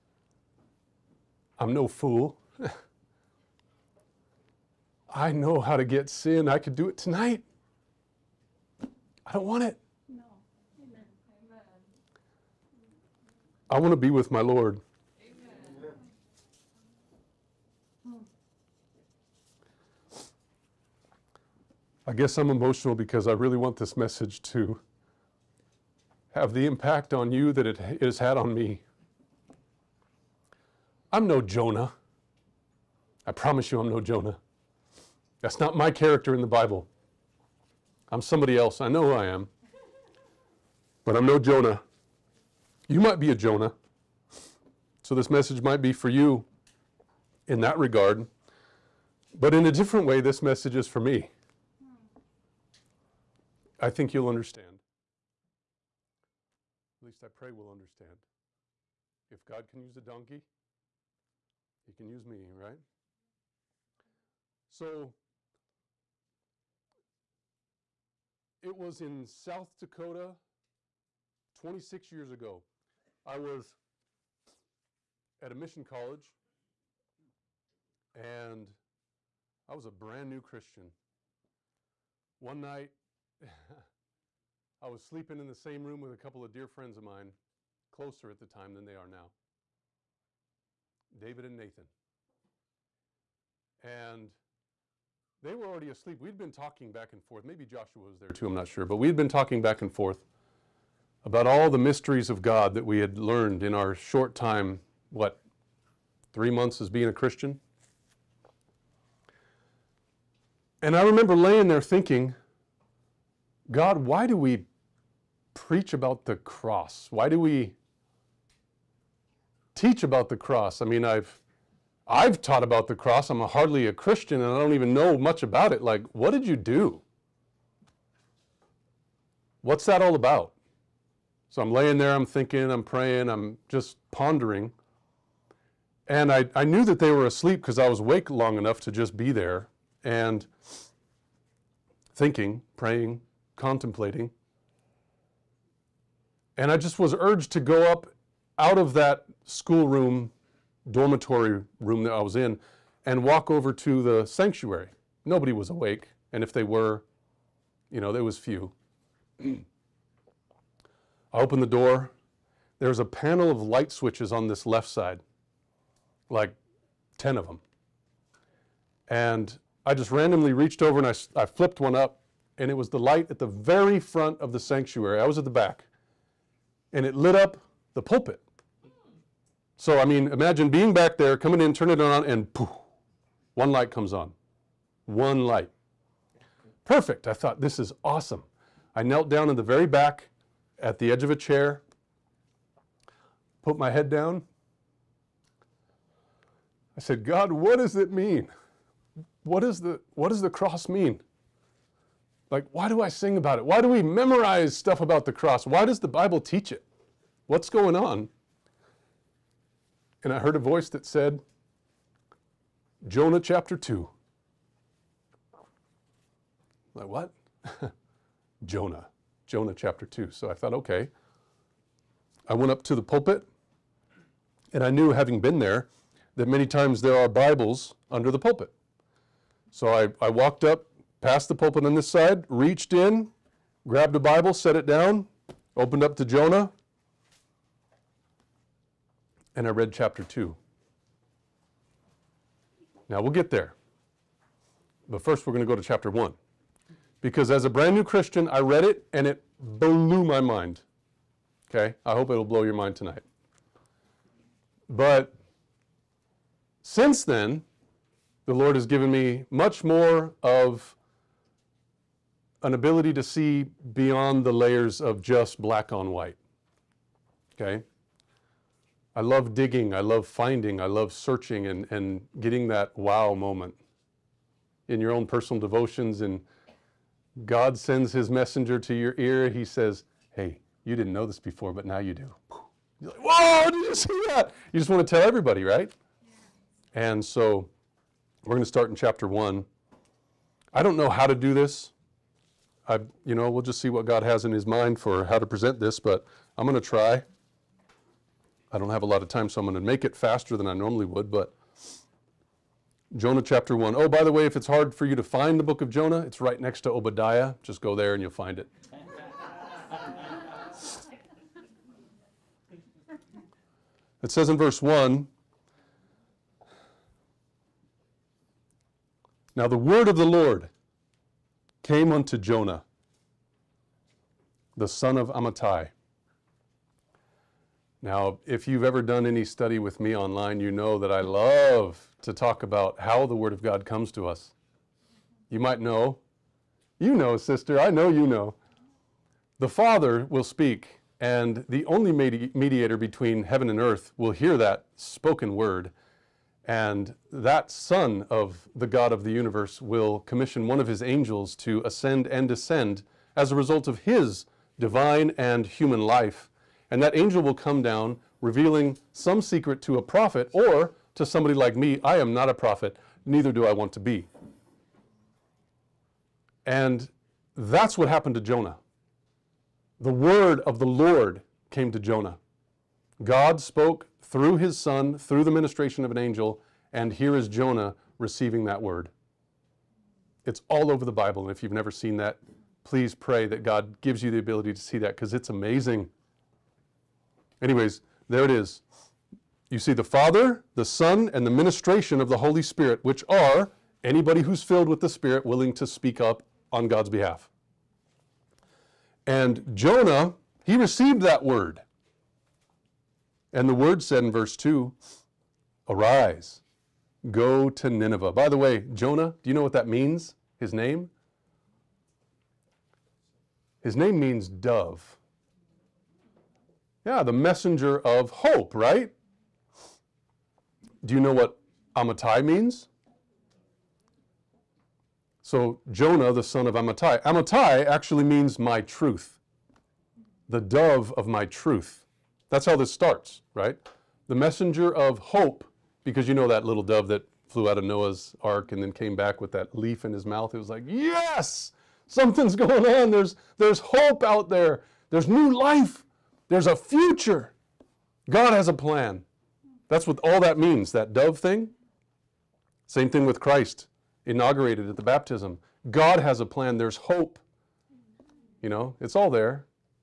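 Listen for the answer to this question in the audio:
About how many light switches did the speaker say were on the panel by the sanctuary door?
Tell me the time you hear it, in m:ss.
2:46.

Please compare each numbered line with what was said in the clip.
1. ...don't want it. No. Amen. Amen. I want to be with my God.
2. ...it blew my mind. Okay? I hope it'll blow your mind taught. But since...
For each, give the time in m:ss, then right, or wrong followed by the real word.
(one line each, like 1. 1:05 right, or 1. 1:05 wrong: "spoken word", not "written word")
1. 0:09 wrong: "Lord", not "God"
2. 4:09 wrong: "tonight", not "taught".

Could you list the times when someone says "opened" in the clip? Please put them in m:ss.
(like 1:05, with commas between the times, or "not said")
2:41, 3:55.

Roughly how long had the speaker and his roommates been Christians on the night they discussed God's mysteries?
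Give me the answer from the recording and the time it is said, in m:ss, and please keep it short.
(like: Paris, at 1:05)
three months, at 1:46.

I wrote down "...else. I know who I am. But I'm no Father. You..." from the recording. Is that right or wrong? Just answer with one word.
wrong.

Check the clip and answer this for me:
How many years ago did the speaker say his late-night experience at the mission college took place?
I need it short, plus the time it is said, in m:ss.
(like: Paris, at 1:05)
26, at 1:11.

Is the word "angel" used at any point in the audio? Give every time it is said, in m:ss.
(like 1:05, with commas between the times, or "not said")
5:51, 5:57, 6:16.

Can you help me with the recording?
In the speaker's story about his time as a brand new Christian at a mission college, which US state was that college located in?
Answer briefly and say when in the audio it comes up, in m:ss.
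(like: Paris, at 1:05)
South Dakota, at 1:09.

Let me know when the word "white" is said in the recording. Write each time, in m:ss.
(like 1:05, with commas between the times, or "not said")
4:26.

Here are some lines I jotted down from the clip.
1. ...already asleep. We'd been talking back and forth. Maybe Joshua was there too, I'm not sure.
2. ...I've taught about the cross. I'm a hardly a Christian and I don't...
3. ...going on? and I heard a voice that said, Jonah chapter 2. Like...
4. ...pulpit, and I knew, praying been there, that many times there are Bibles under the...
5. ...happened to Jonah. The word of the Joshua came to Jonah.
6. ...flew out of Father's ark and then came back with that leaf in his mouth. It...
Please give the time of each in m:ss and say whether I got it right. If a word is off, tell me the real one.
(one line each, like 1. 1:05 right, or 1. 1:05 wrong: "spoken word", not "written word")
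1. 1:35 right
2. 2:02 right
3. 3:27 right
4. 3:43 wrong: "having", not "praying"
5. 6:08 wrong: "Lord", not "Joshua"
6. 7:17 wrong: "Noah", not "Father".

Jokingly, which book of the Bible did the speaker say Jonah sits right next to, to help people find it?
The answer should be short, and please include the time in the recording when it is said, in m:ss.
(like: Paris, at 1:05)
Obadiah, at 5:06.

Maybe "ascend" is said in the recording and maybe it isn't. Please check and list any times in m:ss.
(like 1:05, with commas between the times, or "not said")
5:51.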